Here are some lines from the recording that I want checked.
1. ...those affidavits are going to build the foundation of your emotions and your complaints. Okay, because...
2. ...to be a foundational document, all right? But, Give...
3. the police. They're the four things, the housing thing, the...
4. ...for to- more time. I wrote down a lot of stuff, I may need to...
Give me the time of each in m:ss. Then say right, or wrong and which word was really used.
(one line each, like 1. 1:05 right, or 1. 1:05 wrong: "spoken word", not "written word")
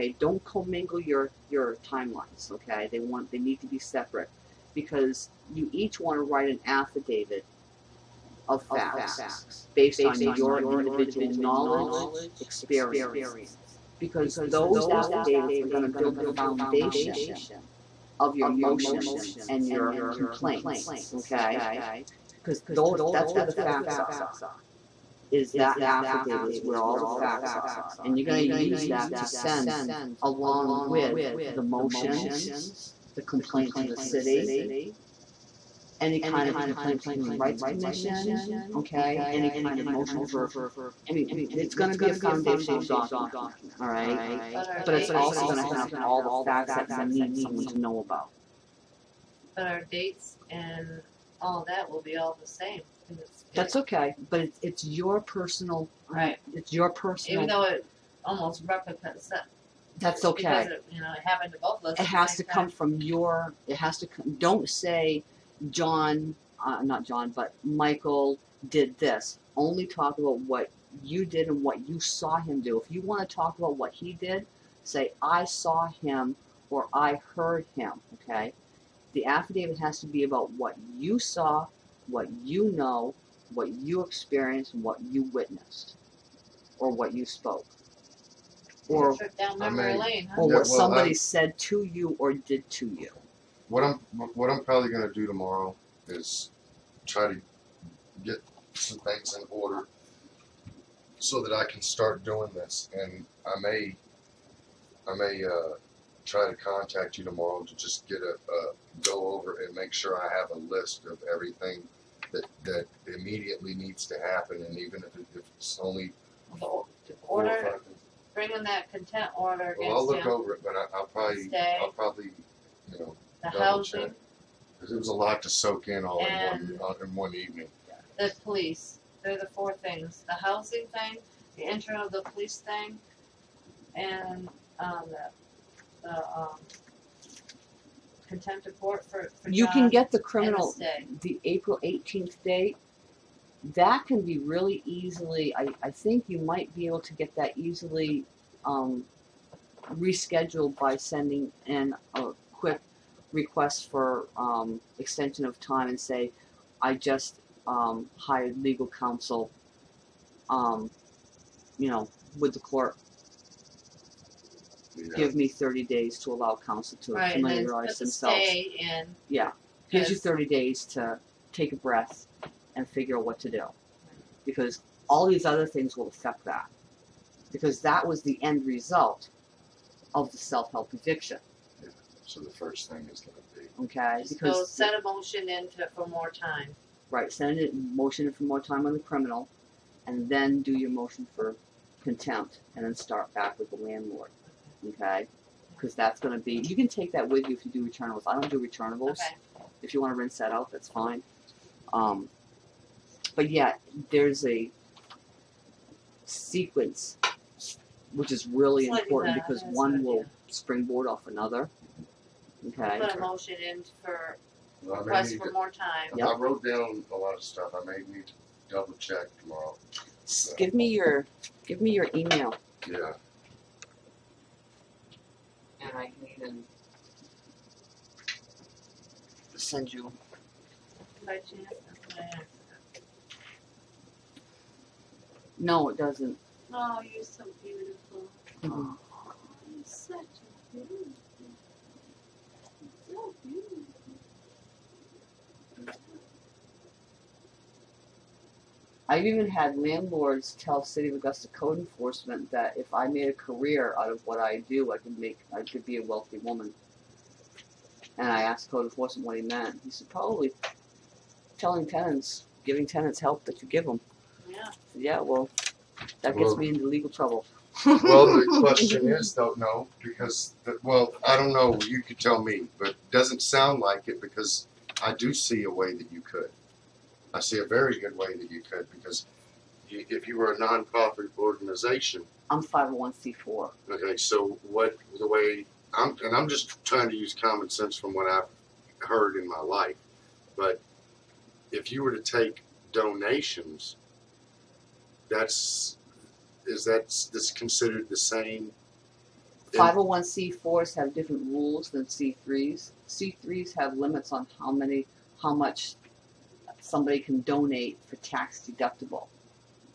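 1. 0:14 right
2. 0:41 wrong: "But", not "Give"
3. 2:08 right
4. 3:35 right.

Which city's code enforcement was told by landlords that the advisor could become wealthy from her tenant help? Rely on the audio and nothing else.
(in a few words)
Augusta.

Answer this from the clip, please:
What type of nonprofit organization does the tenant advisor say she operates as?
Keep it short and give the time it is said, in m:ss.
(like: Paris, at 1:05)
501c4, at 4:42.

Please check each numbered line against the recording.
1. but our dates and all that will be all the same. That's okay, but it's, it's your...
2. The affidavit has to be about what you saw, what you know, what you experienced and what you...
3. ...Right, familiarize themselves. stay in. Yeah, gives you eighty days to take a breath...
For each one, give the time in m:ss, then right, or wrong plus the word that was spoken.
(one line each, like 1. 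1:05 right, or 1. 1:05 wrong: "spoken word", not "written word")
1. 0:49 right
2. 1:19 right
3. 2:47 wrong: "thirty", not "eighty".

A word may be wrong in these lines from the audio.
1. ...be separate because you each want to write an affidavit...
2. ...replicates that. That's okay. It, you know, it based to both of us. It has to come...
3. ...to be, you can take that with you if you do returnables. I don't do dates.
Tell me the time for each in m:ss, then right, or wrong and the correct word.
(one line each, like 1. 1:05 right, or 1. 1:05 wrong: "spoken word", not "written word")
1. 0:03 right
2. 0:58 wrong: "happened", not "based"
3. 3:16 wrong: "returnables", not "dates".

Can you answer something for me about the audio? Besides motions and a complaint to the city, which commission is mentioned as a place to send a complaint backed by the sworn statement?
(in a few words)
Human Rights Commission.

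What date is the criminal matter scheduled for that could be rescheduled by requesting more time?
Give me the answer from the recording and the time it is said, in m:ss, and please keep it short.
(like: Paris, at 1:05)
April 18, at 2:21.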